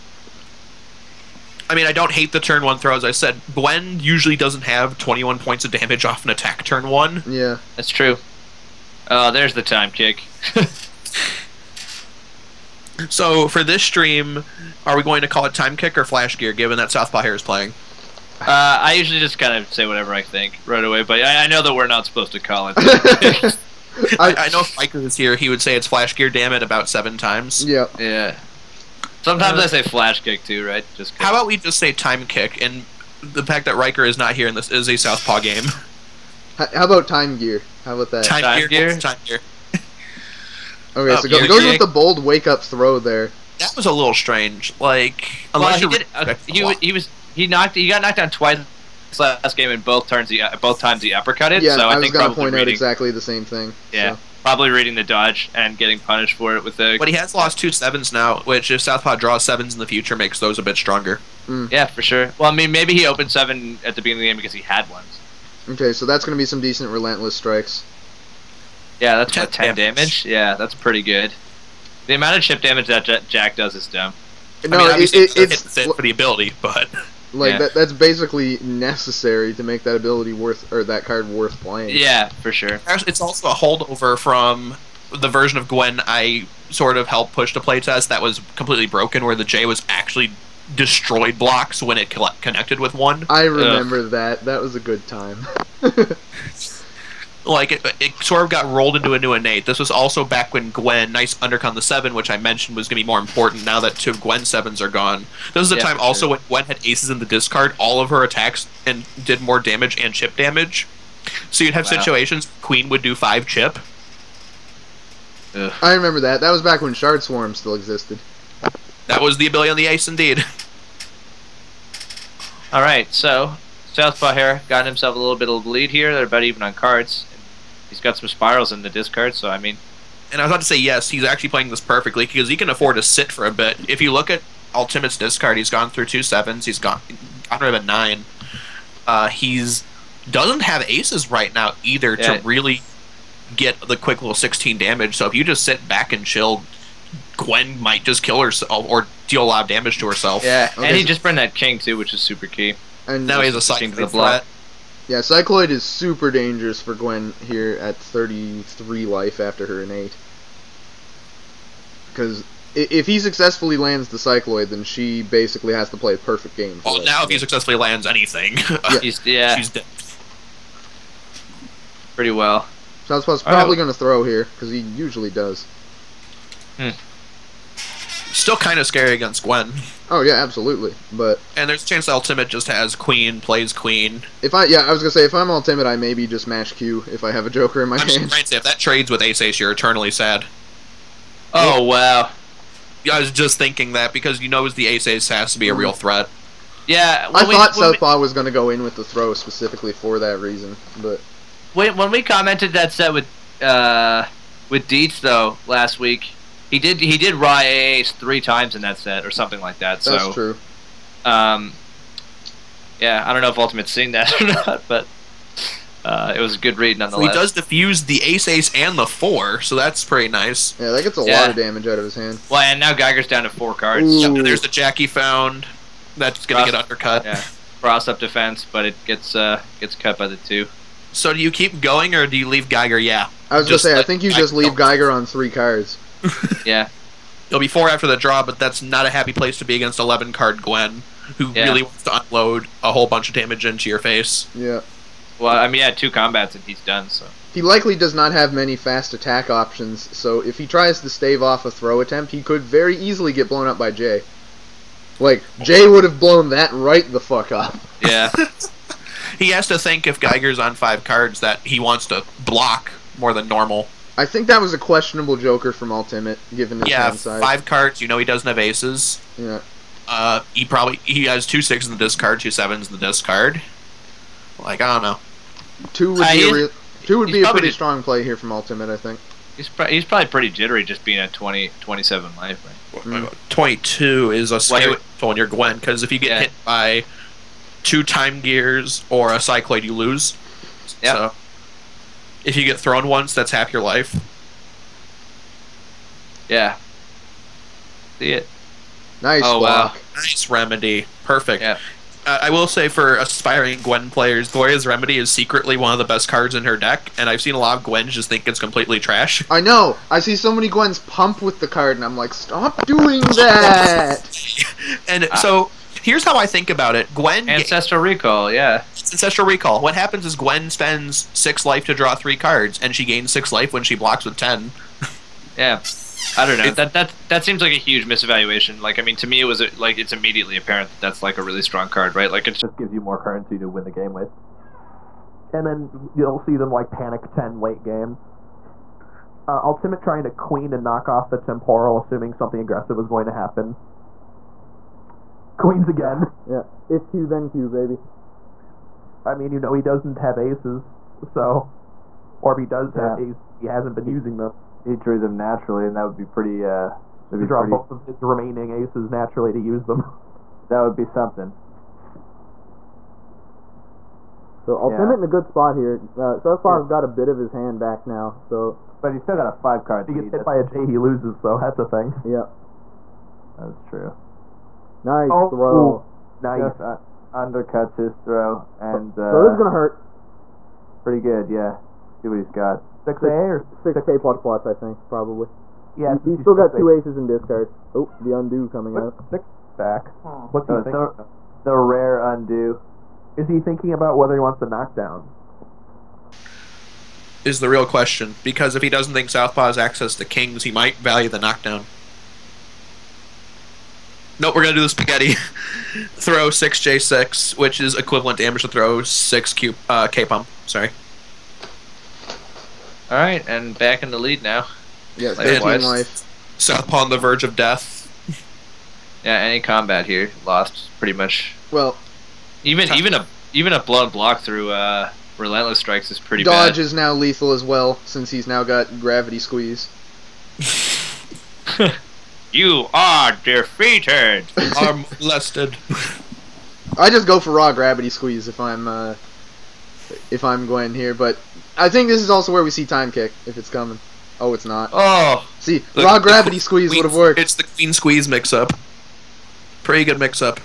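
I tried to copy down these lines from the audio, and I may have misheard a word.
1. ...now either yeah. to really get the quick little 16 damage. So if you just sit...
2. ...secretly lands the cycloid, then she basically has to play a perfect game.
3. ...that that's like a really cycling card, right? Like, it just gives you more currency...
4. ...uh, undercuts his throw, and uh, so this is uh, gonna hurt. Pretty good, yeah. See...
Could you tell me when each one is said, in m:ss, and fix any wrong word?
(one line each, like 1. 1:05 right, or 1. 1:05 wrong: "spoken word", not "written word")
1. 2:21 right
2. 2:43 wrong: "successfully", not "secretly"
3. 5:30 wrong: "strong", not "cycling"
4. 6:17 right.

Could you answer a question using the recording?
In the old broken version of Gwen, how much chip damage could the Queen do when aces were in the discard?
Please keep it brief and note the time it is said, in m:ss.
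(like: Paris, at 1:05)
5, at 1:53.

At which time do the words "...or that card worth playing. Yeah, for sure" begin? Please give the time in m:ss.
1:20.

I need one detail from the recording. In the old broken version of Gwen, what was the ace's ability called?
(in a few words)
Shard Swarm.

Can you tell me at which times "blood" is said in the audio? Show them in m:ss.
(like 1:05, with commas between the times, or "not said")
2:34, 7:03.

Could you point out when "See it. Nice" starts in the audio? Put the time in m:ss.
4:58.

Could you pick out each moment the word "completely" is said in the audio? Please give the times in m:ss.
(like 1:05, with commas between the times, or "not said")
1:28, 5:08.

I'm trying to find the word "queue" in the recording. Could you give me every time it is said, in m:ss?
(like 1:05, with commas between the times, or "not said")
not said.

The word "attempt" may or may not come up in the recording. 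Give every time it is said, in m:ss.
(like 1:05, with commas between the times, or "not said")
4:11.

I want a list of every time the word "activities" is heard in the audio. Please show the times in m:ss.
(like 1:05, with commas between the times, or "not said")
not said.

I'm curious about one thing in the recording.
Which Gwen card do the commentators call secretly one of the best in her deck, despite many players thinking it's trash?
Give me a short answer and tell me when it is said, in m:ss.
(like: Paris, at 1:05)
Glorious Remedy, at 5:04.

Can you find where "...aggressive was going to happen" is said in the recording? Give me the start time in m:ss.
5:42.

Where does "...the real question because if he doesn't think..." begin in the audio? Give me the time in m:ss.
6:37.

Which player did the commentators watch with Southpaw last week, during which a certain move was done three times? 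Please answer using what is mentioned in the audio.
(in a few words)
Deets.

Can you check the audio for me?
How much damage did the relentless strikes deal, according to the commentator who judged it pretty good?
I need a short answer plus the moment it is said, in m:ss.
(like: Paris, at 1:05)
10, at 1:09.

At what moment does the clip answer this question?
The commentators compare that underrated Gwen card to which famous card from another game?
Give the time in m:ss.
5:18.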